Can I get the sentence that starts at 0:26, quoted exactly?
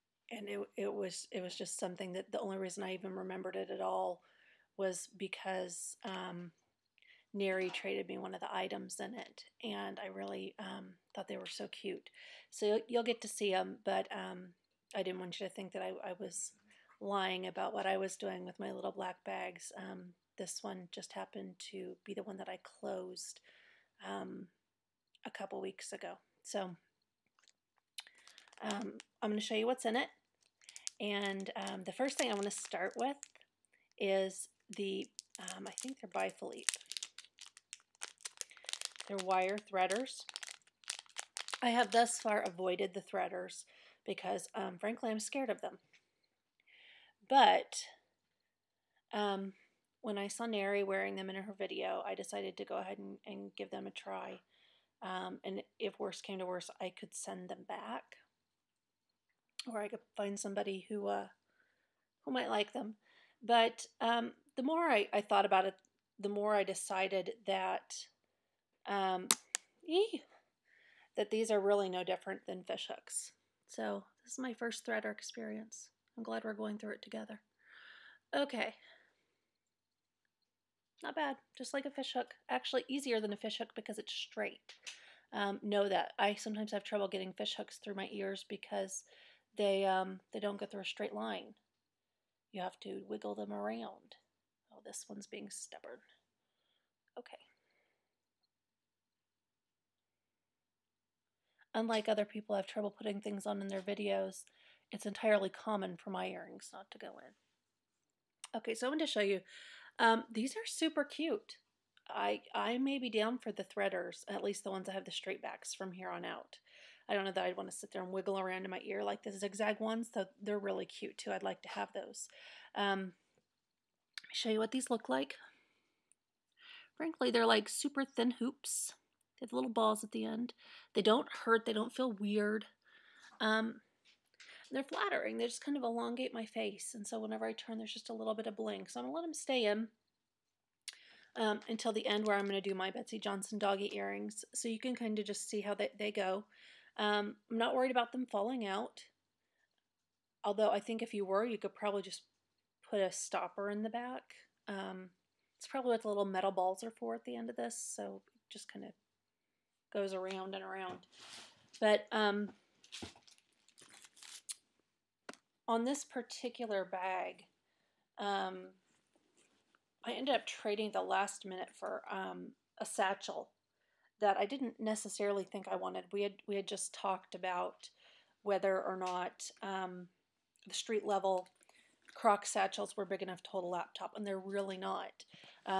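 So um, I'm going to show you what's in it.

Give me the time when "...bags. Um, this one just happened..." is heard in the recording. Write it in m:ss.
0:19.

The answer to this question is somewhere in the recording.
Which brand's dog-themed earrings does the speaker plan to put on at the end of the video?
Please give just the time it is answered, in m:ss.
2:22.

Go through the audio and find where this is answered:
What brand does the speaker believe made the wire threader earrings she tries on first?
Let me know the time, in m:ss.
0:36.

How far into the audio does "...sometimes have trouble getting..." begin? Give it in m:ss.
1:26.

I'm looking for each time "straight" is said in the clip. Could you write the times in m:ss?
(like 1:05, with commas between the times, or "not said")
1:24, 1:30, 1:55.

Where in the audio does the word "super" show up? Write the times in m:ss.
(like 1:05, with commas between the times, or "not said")
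1:50, 2:07.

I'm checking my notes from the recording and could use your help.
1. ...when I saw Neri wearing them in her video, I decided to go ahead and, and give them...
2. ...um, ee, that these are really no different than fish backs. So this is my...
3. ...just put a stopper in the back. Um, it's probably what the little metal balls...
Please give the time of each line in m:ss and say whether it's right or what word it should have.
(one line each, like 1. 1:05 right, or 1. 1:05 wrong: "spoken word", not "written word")
1. 0:50 right
2. 1:08 wrong: "hooks", not "backs"
3. 2:32 right.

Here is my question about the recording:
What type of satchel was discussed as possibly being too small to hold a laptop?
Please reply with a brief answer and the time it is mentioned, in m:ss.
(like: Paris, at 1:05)
street level croc satchels, at 3:00.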